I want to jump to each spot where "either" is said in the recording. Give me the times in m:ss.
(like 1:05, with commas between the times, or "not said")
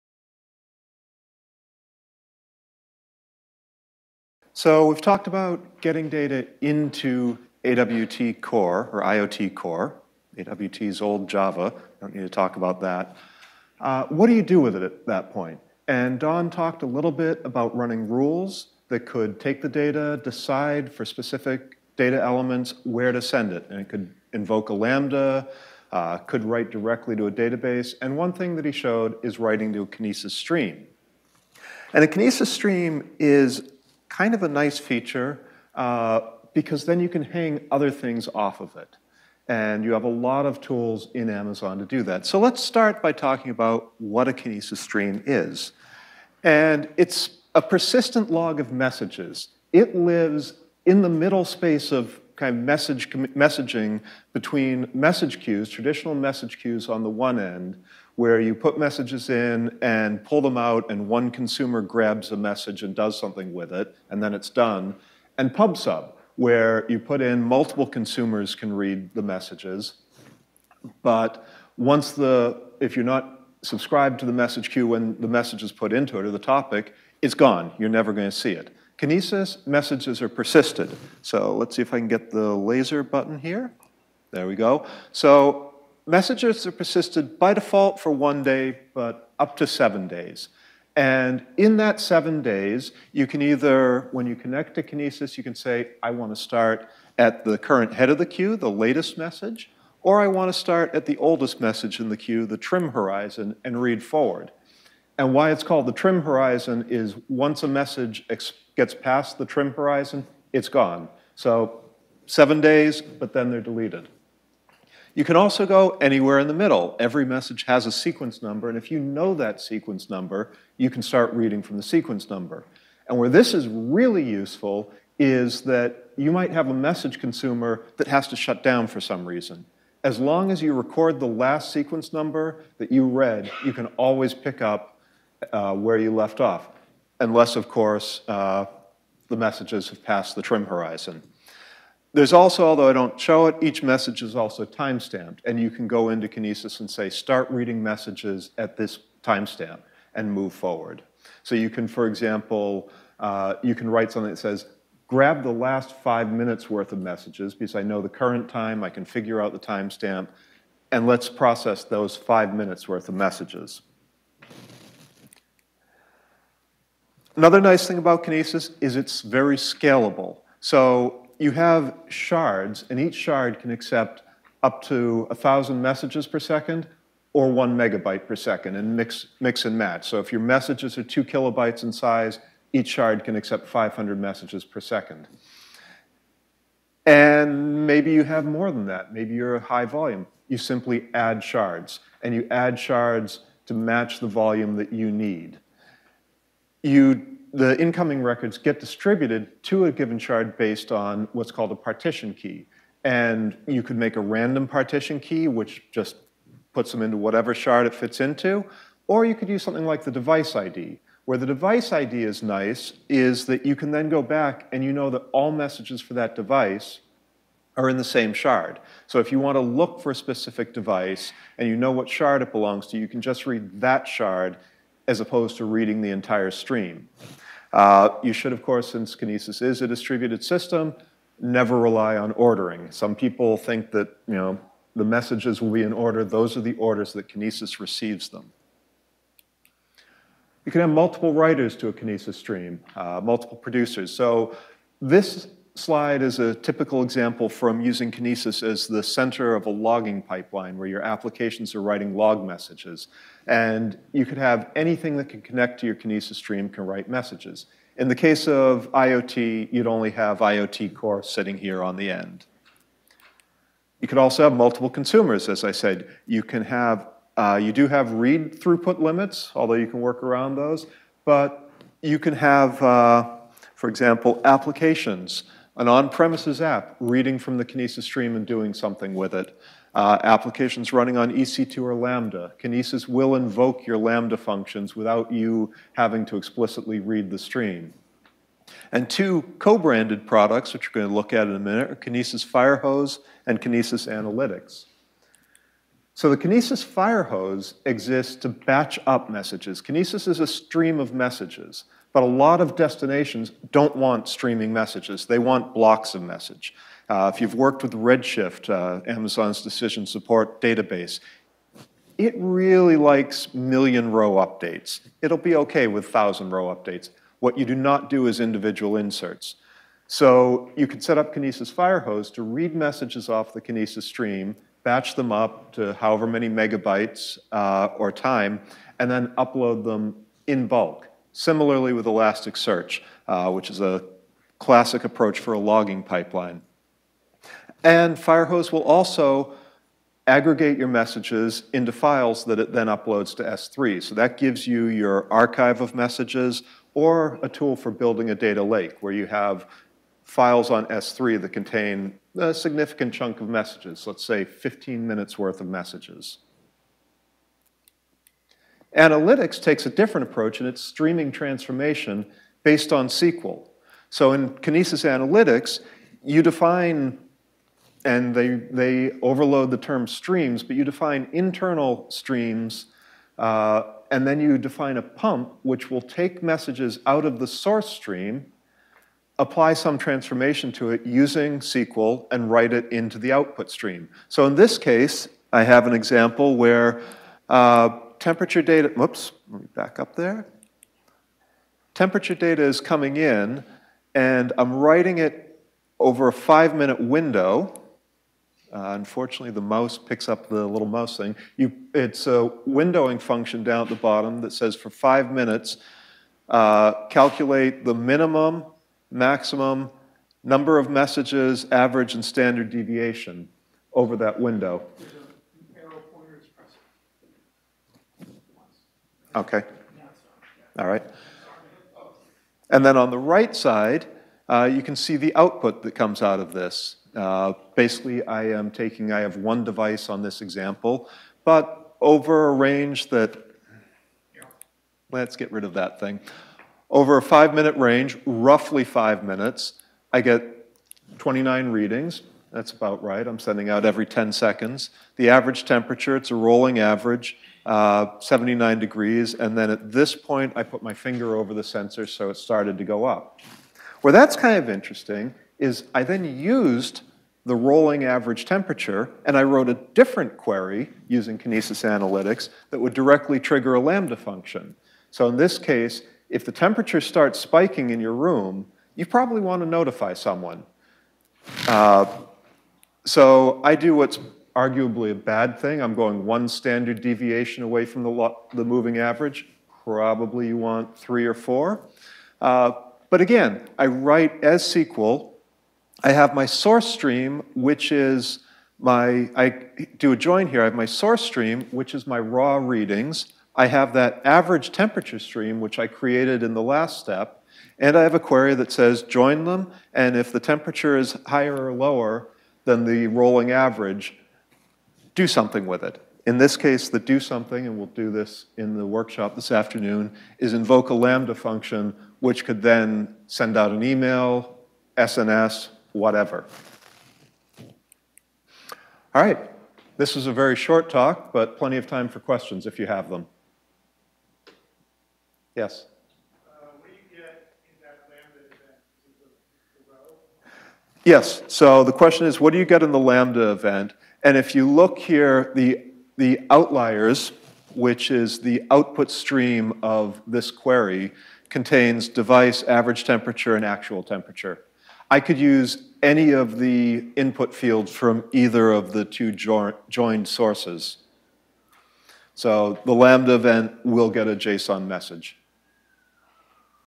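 1:33, 9:08.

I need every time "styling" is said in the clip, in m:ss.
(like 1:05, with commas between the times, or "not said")
not said.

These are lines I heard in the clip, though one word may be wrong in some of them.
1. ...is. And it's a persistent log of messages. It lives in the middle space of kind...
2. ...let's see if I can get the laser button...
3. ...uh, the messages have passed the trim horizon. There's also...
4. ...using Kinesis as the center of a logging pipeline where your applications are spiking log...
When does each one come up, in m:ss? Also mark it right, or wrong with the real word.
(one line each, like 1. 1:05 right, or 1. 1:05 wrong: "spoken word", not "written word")
1. 0:45 right
2. 1:21 right
3. 2:18 right
4. 4:07 wrong: "writing", not "spiking".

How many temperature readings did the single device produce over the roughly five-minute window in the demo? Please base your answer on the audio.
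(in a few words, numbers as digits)
29.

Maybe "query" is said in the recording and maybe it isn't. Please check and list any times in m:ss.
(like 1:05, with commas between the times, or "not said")
7:40, 8:18, 9:00.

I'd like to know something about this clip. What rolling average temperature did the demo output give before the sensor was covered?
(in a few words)
79 degrees.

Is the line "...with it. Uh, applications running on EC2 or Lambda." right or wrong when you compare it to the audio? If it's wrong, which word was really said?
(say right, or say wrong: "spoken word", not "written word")
right.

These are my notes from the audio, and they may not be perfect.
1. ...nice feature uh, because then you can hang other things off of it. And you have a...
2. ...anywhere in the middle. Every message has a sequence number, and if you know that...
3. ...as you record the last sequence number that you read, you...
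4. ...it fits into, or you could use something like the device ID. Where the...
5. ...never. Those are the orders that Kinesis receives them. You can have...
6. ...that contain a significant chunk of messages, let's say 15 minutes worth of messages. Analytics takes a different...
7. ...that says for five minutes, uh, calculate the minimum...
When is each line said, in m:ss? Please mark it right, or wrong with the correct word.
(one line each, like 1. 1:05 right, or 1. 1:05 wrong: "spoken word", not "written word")
1. 0:34 right
2. 1:56 right
3. 2:10 right
4. 3:27 right
5. 3:55 wrong: "order", not "never"
6. 5:51 right
7. 6:44 right.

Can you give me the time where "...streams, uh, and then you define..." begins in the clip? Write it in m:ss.
6:12.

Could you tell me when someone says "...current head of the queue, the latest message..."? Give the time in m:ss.
1:37.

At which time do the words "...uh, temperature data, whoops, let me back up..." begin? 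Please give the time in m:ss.
6:27.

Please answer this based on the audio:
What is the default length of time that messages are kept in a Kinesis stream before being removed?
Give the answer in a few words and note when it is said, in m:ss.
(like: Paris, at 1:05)
1 day, at 1:28.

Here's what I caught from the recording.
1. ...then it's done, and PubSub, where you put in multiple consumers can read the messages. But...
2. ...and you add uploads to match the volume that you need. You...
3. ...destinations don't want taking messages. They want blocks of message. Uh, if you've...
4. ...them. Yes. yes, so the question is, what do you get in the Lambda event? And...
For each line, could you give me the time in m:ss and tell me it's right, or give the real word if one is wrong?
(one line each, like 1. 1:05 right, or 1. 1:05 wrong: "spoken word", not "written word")
1. 1:04 right
2. 3:12 wrong: "shards", not "uploads"
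3. 5:02 wrong: "streaming", not "taking"
4. 8:43 right.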